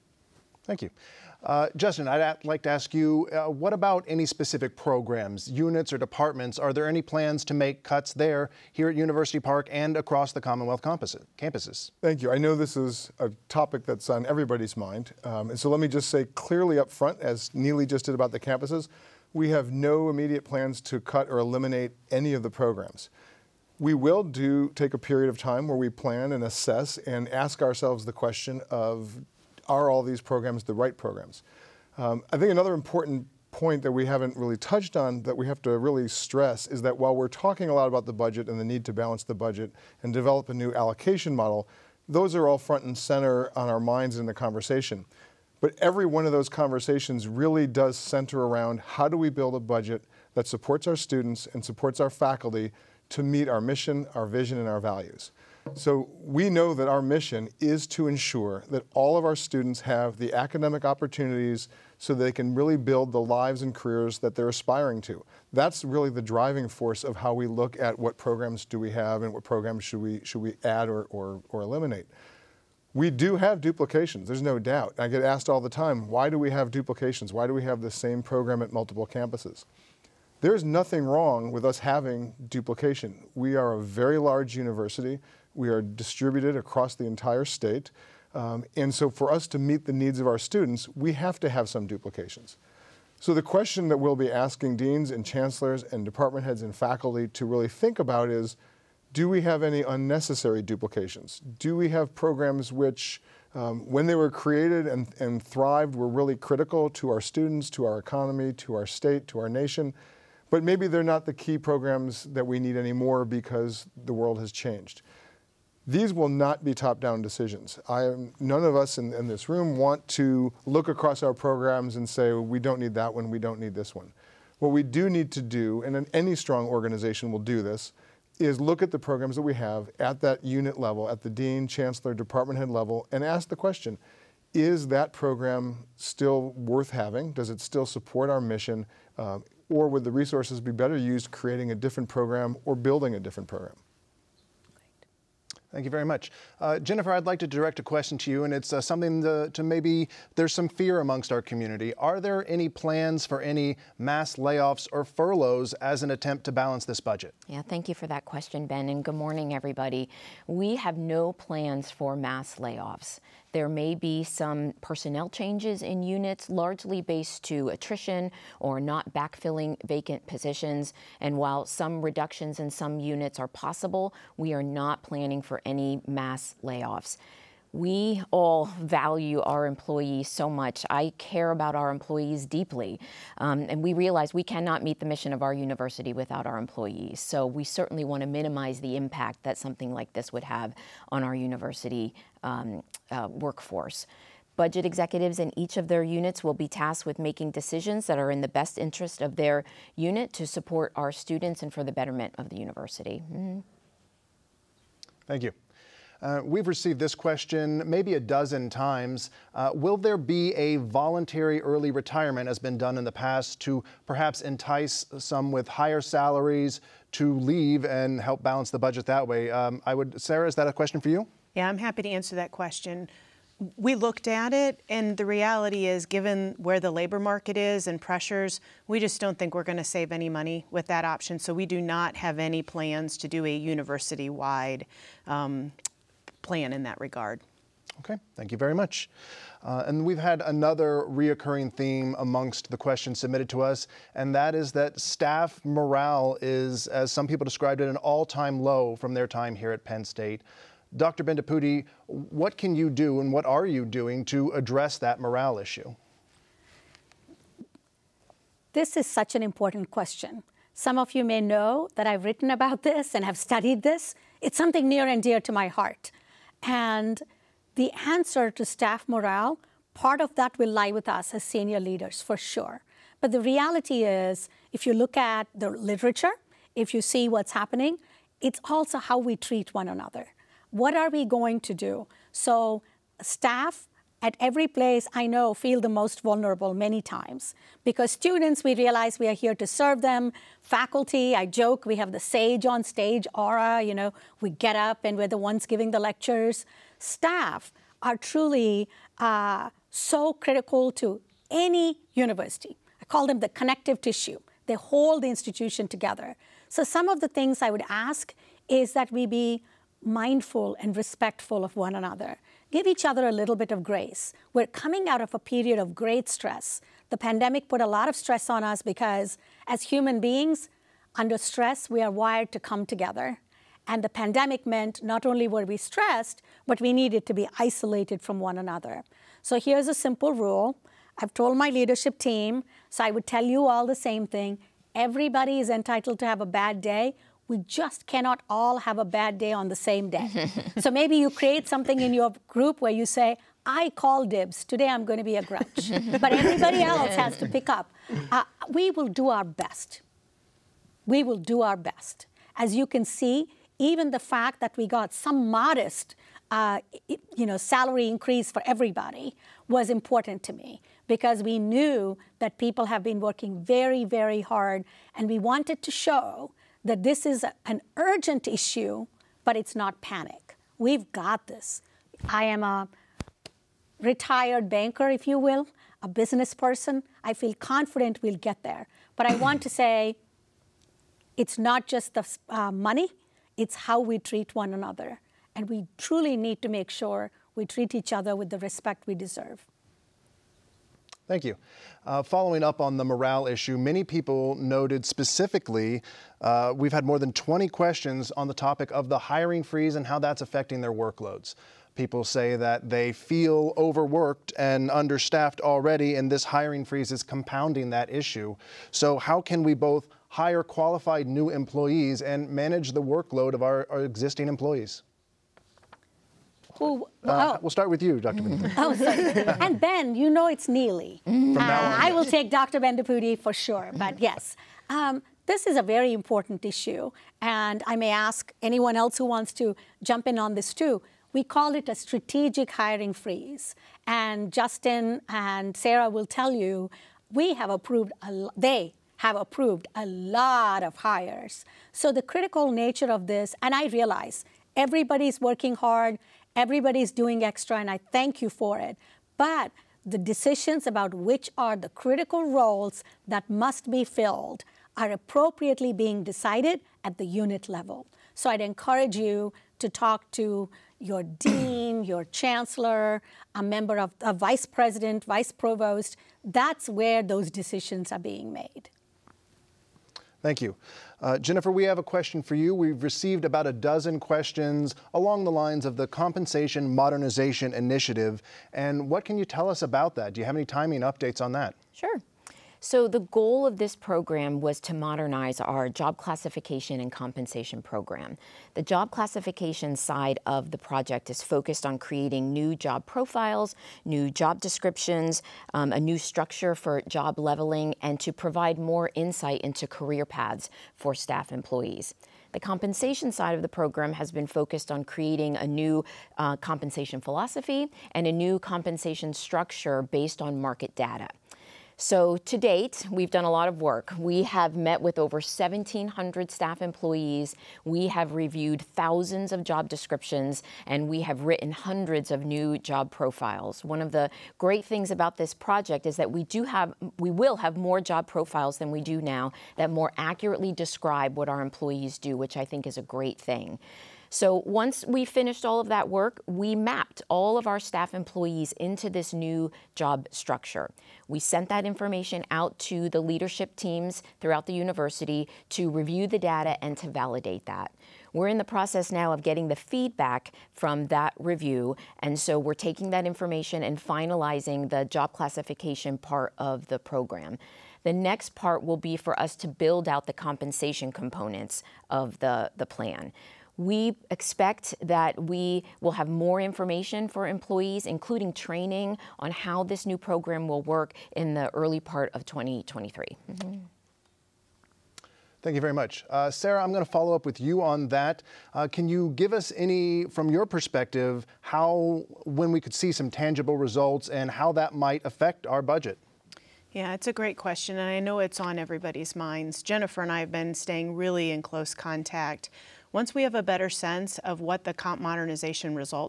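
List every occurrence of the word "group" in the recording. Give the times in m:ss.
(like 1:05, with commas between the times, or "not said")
5:42.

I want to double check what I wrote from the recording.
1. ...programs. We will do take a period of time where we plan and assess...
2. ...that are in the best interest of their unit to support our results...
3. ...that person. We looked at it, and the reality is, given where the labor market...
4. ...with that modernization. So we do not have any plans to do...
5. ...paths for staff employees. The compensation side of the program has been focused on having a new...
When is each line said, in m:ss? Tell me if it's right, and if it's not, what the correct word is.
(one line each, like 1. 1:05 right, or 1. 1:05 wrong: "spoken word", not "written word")
1. 0:22 right
2. 3:18 wrong: "students", not "results"
3. 3:42 wrong: "question", not "person"
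4. 3:50 wrong: "option", not "modernization"
5. 8:20 wrong: "creating", not "having".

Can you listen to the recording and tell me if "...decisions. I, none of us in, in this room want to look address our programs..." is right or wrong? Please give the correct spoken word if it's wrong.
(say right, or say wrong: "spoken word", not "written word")
wrong: "across", not "address".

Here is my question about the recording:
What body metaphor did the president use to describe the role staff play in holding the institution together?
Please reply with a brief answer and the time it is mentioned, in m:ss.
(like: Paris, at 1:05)
Connective tissue, at 5:03.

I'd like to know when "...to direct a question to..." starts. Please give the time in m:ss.
2:27.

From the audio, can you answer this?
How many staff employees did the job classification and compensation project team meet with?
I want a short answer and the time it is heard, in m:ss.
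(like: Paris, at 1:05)
Over 1,700, at 8:35.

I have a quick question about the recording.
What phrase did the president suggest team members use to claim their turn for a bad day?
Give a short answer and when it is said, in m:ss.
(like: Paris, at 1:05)
I call dibs, at 5:43.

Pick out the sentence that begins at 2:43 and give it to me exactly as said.
There may be some personnel changes in units, largely based to attrition or not backfilling vacant positions.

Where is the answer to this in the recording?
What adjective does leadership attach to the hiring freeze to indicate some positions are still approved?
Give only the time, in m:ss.
7:11.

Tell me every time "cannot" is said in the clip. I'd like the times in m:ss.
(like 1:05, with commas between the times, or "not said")
3:04, 5:38.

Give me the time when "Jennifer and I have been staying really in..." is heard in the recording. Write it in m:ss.
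9:49.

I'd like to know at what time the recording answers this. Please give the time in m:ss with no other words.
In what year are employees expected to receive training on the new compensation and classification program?
9:32.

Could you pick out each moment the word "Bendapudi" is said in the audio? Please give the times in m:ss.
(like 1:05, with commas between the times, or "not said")
4:11, 7:02.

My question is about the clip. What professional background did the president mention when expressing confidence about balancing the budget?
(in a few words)
Retired banker.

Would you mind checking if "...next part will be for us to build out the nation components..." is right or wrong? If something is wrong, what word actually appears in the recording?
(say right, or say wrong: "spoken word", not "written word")
wrong: "compensation", not "nation".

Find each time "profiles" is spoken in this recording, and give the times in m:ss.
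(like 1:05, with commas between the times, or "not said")
8:13, 8:43, 8:48.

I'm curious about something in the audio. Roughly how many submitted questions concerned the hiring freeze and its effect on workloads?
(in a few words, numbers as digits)
More than 20.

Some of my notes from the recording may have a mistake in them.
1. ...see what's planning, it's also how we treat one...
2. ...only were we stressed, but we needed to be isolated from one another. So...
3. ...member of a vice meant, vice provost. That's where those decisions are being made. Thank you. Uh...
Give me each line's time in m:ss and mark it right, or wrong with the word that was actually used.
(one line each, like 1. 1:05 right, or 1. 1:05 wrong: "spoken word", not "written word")
1. 4:37 wrong: "happening", not "planning"
2. 5:25 right
3. 7:43 wrong: "president", not "meant".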